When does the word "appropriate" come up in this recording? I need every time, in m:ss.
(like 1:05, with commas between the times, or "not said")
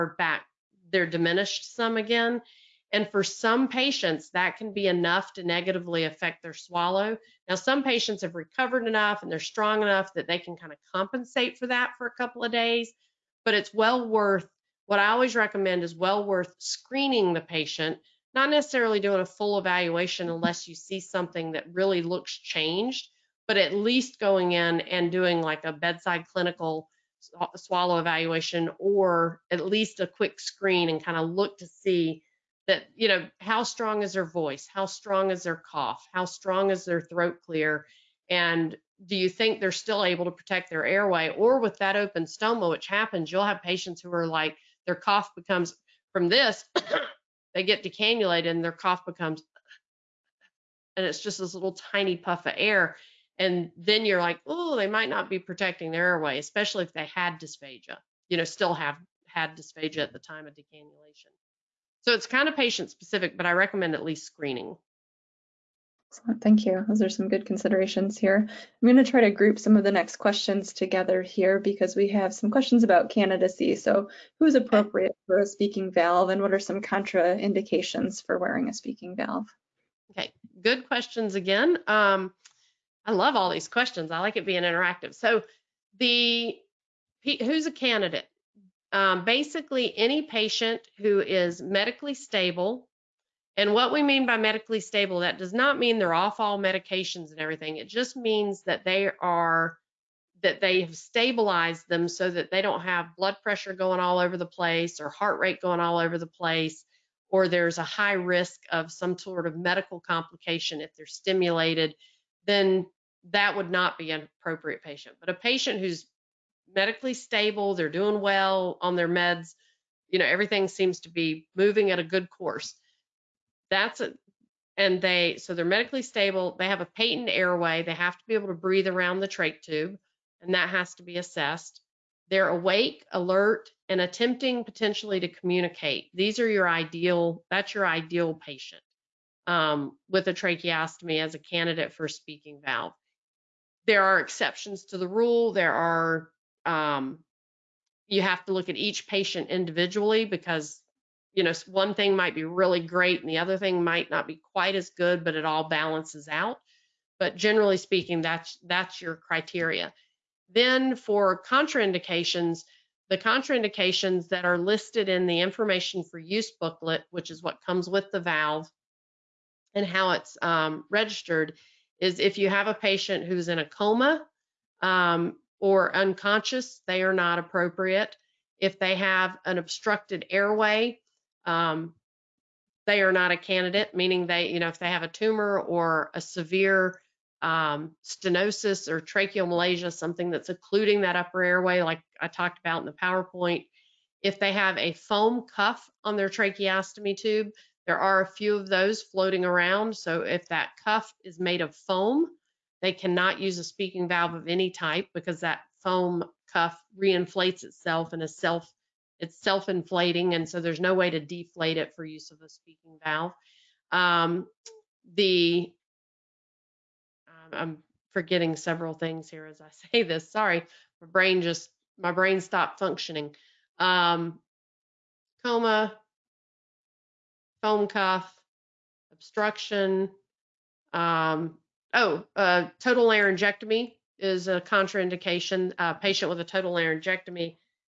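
1:14, 1:54, 2:57.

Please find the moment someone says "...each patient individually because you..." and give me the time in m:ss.
2:28.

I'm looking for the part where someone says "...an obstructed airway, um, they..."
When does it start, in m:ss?
2:59.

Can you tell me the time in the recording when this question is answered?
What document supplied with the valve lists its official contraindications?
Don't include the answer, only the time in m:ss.
2:45.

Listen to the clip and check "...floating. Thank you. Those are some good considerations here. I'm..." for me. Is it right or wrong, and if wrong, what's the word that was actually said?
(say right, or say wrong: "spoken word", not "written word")
wrong: "screening", not "floating".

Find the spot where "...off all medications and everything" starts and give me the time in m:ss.
1:36.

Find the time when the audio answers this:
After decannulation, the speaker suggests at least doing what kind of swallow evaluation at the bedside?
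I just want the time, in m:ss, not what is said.
0:26.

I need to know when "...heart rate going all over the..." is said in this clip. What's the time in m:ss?
1:45.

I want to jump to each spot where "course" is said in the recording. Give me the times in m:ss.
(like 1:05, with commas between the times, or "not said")
2:02.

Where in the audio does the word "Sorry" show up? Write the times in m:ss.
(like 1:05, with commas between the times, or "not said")
3:40.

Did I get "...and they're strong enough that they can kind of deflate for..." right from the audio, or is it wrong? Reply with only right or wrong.
wrong.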